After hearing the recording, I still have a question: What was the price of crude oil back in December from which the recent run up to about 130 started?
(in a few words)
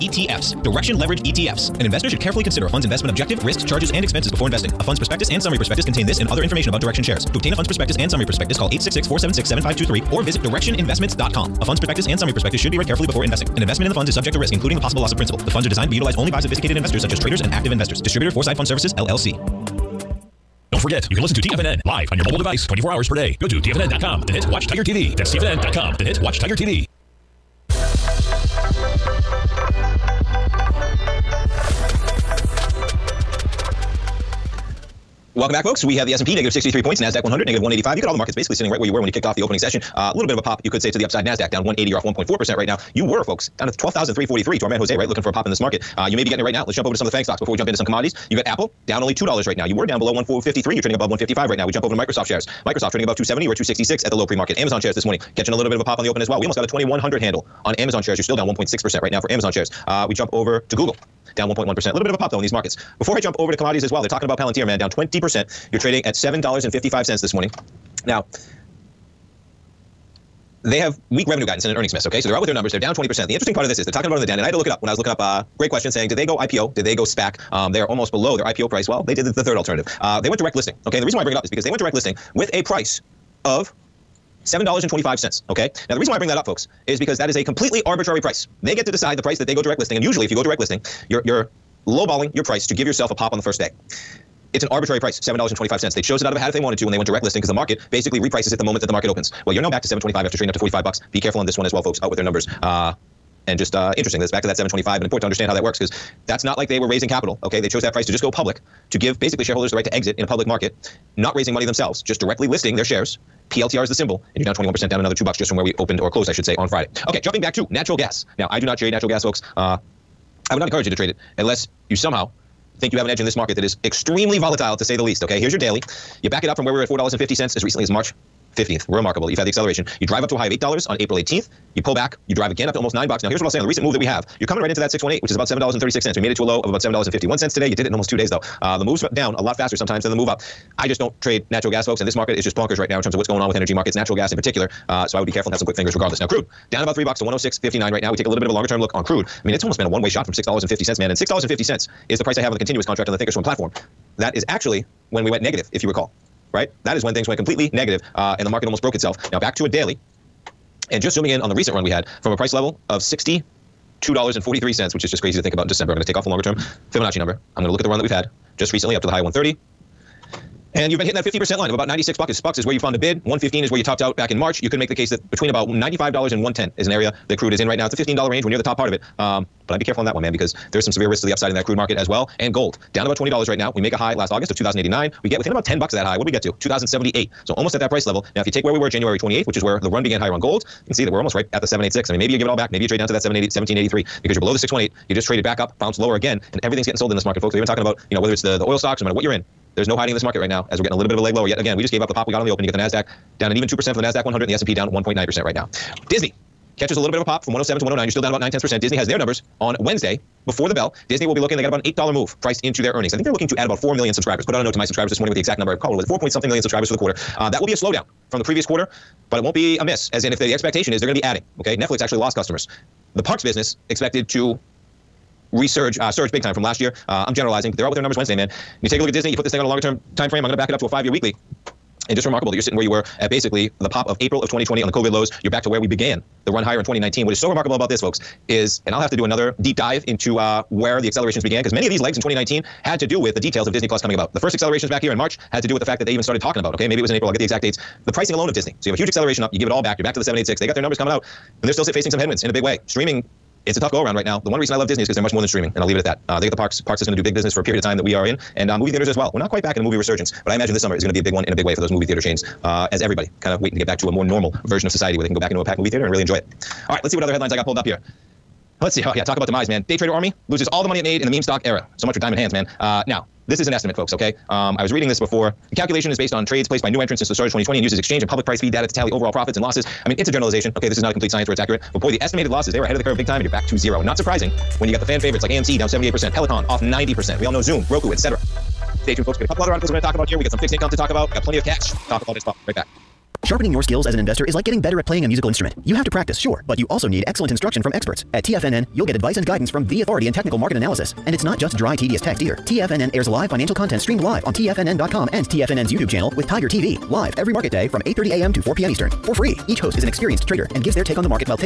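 $62.43.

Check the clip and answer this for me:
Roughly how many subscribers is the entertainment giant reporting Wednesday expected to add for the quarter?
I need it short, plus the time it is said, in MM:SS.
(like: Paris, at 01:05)
4 million, at 03:33.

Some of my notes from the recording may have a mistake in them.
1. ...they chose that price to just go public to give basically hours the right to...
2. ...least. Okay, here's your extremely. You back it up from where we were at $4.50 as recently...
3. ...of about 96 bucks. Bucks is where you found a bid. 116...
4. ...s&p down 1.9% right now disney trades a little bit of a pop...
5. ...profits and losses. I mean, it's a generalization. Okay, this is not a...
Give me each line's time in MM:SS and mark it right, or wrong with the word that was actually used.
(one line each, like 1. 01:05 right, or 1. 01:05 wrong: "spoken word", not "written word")
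1. 01:47 wrong: "shareholders", not "hours"
2. 02:05 wrong: "daily", not "extremely"
3. 02:51 wrong: "115", not "116"
4. 03:24 wrong: "catches", not "trades"
5. 04:39 right.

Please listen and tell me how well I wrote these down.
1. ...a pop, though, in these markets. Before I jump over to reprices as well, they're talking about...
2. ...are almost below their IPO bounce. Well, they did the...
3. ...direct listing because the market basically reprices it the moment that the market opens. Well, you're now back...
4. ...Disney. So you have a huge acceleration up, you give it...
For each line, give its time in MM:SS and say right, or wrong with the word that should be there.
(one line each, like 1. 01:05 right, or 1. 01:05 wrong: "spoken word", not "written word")
1. 01:02 wrong: "commodities", not "reprices"
2. 01:17 wrong: "price", not "bounce"
3. 01:37 right
4. 04:08 right.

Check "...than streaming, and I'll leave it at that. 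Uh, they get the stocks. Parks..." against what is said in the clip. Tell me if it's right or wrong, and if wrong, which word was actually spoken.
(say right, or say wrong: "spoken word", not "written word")
wrong: "parks", not "stocks".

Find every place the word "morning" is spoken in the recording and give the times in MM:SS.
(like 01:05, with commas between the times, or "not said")
00:55, 01:07, 03:35.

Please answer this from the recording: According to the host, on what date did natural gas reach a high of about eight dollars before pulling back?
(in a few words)
April 18th.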